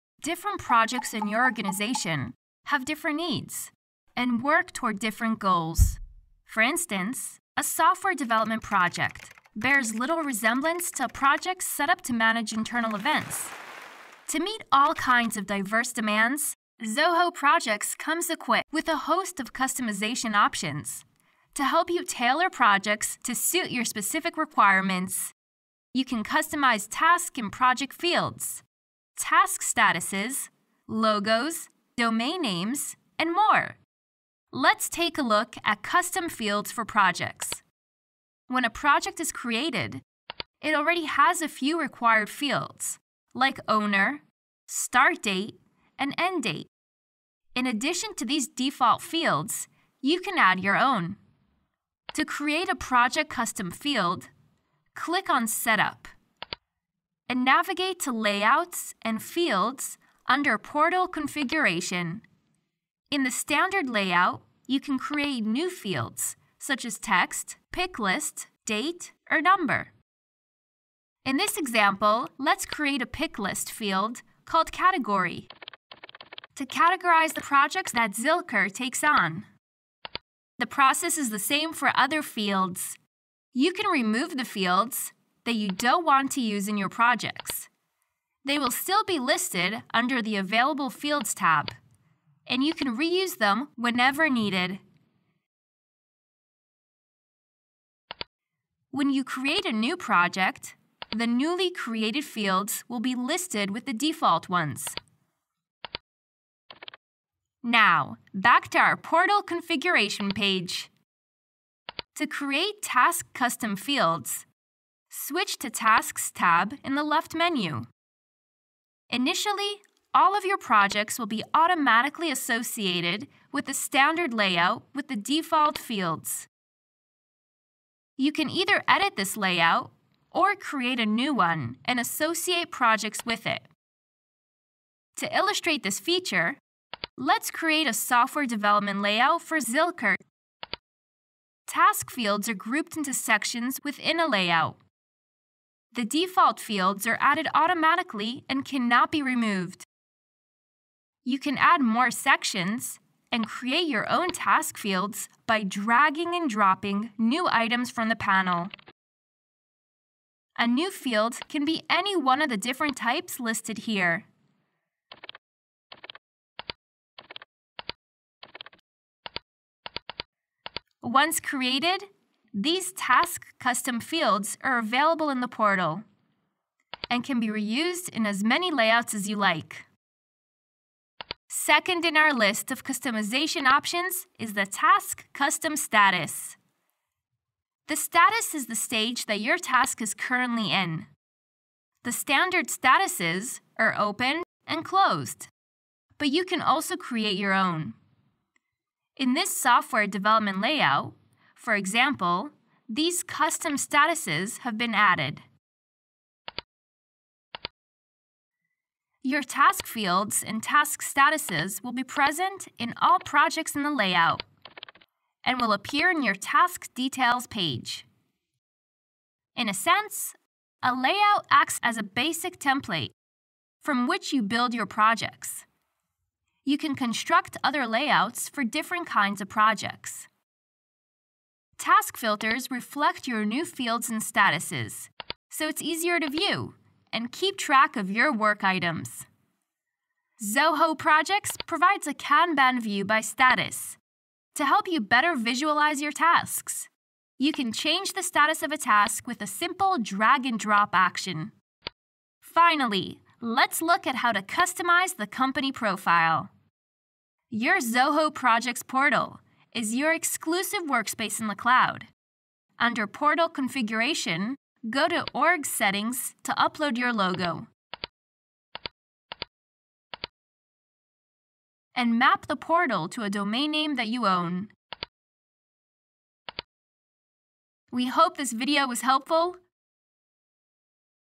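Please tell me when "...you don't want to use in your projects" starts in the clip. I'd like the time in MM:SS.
01:25.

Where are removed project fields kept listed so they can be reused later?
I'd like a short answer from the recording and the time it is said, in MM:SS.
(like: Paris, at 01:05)
Available Fields tab, at 01:30.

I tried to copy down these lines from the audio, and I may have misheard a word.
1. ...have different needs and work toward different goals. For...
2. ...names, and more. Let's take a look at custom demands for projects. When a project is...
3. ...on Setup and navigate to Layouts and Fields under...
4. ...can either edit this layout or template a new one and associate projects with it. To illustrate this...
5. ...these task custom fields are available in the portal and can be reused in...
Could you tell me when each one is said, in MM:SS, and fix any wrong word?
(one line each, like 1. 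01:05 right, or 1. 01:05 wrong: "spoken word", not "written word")
1. 00:02 right
2. 00:32 wrong: "fields", not "demands"
3. 00:55 right
4. 02:08 wrong: "create", not "template"
5. 02:52 right.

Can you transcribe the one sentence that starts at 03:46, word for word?
You can construct other layouts for different kinds of projects.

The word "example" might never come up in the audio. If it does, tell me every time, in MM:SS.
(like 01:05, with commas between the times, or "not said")
01:11, 03:21.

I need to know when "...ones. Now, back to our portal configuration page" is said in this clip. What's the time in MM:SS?
01:44.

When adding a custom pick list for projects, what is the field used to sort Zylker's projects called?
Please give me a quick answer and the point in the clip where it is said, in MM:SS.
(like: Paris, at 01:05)
Category, at 01:14.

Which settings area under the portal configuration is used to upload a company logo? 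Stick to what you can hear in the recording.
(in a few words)
Org Settings.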